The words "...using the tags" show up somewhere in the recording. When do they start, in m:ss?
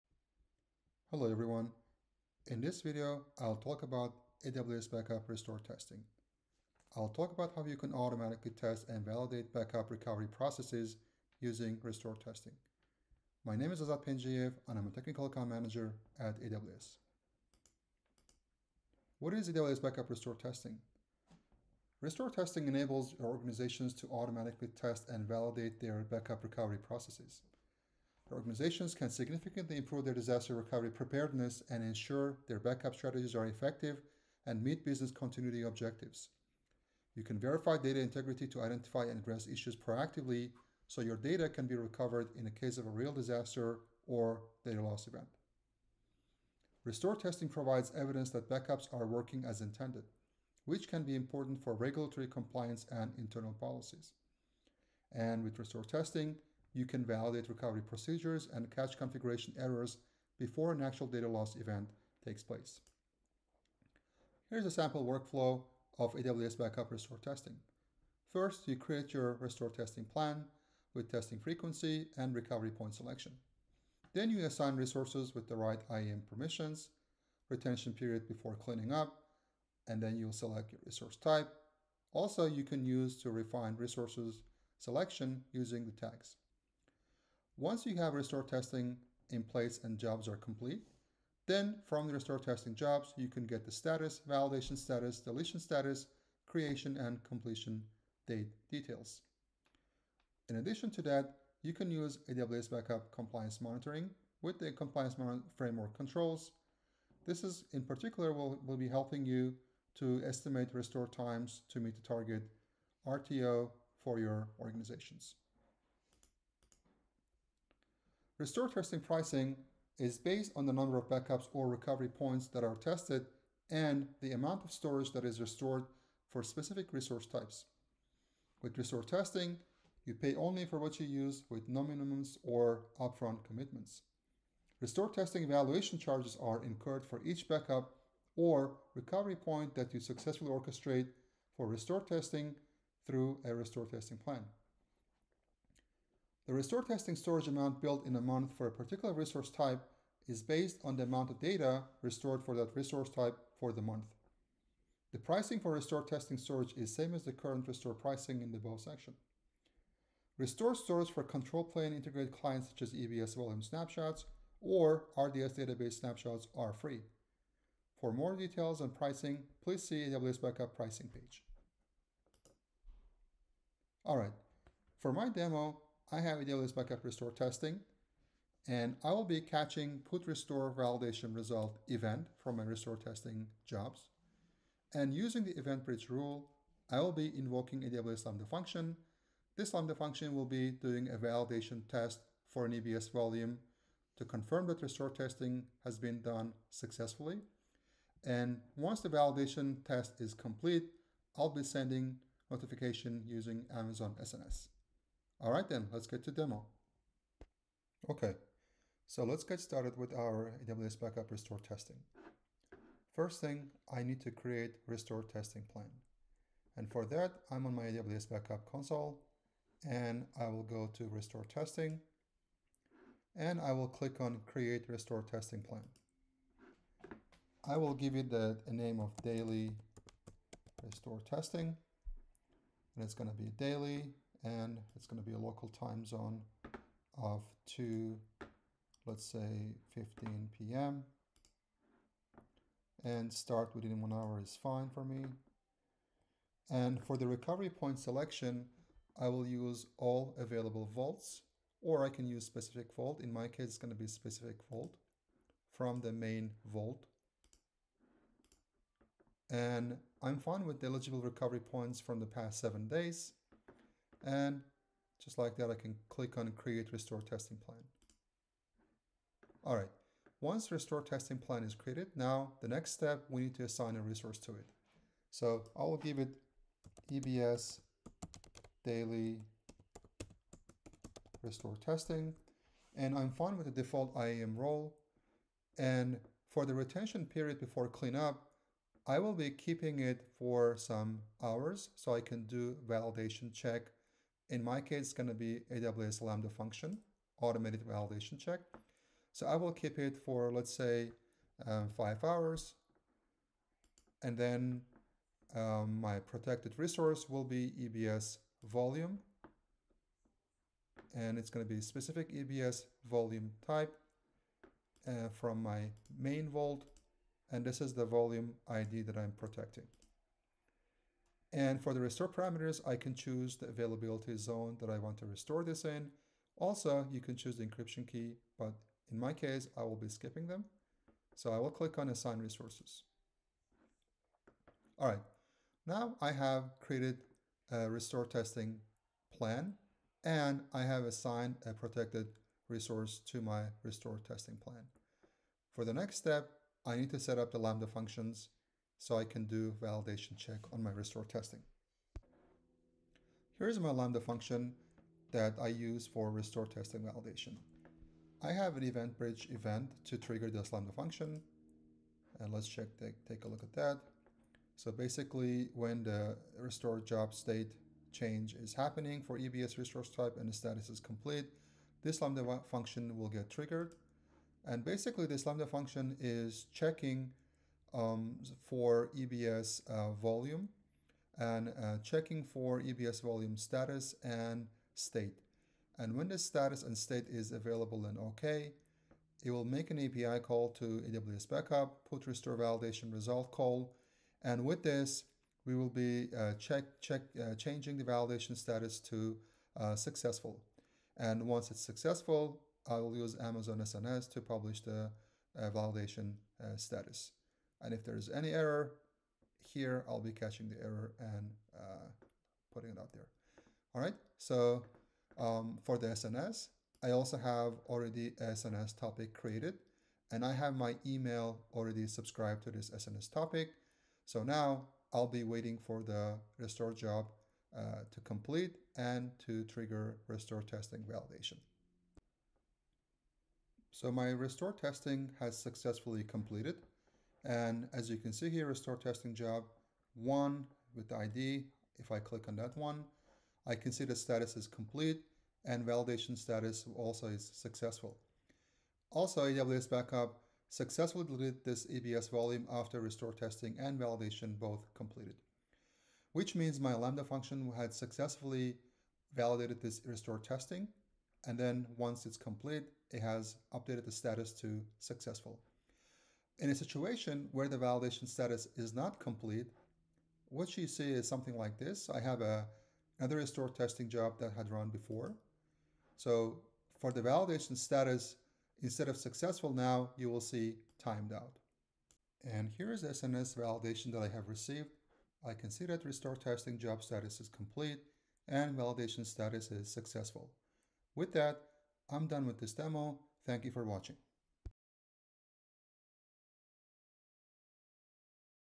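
1:25.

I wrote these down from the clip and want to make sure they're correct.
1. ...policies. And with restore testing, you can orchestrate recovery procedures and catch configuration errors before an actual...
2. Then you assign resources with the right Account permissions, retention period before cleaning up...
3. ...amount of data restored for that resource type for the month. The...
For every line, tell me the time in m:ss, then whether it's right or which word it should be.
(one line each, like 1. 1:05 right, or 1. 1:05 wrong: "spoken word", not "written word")
1. 0:53 wrong: "validate", not "orchestrate"
2. 1:14 wrong: "IAM", not "Account"
3. 2:31 right.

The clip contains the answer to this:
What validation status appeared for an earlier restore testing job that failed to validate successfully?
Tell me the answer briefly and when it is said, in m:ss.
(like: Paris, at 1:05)
timed out, at 8:01.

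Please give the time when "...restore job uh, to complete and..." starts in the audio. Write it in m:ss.
7:06.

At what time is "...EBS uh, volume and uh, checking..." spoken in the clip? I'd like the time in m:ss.
6:19.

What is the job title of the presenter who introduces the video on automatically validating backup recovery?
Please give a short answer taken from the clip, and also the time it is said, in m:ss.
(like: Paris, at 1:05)
Technical Account Manager, at 0:14.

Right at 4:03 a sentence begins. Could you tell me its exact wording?
And start within one hour is fine for me.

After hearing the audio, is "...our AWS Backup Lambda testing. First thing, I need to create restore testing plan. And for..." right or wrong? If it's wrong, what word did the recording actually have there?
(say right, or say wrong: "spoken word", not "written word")
wrong: "Restore", not "Lambda".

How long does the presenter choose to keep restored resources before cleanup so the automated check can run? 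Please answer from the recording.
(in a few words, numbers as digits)
5 hours.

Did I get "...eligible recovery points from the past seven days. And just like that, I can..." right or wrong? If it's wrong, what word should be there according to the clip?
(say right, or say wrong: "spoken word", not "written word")
right.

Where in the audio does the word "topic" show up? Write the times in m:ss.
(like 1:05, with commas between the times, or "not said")
6:58, 7:03.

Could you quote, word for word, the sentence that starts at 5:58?
I have an event bridge event to trigger this Lambda function.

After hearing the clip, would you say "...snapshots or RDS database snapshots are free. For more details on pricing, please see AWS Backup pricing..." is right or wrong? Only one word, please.
right.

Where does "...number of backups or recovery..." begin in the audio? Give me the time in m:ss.
2:00.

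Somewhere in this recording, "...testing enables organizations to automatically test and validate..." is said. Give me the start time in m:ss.
0:22.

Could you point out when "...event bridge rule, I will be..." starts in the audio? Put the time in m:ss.
3:05.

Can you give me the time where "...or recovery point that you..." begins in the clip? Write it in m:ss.
2:18.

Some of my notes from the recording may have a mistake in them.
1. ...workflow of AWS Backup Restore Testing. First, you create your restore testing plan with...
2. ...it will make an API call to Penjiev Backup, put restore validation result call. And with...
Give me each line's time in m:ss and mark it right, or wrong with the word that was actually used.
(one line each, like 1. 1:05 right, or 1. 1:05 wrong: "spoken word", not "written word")
1. 1:05 right
2. 6:29 wrong: "AWS", not "Penjiev".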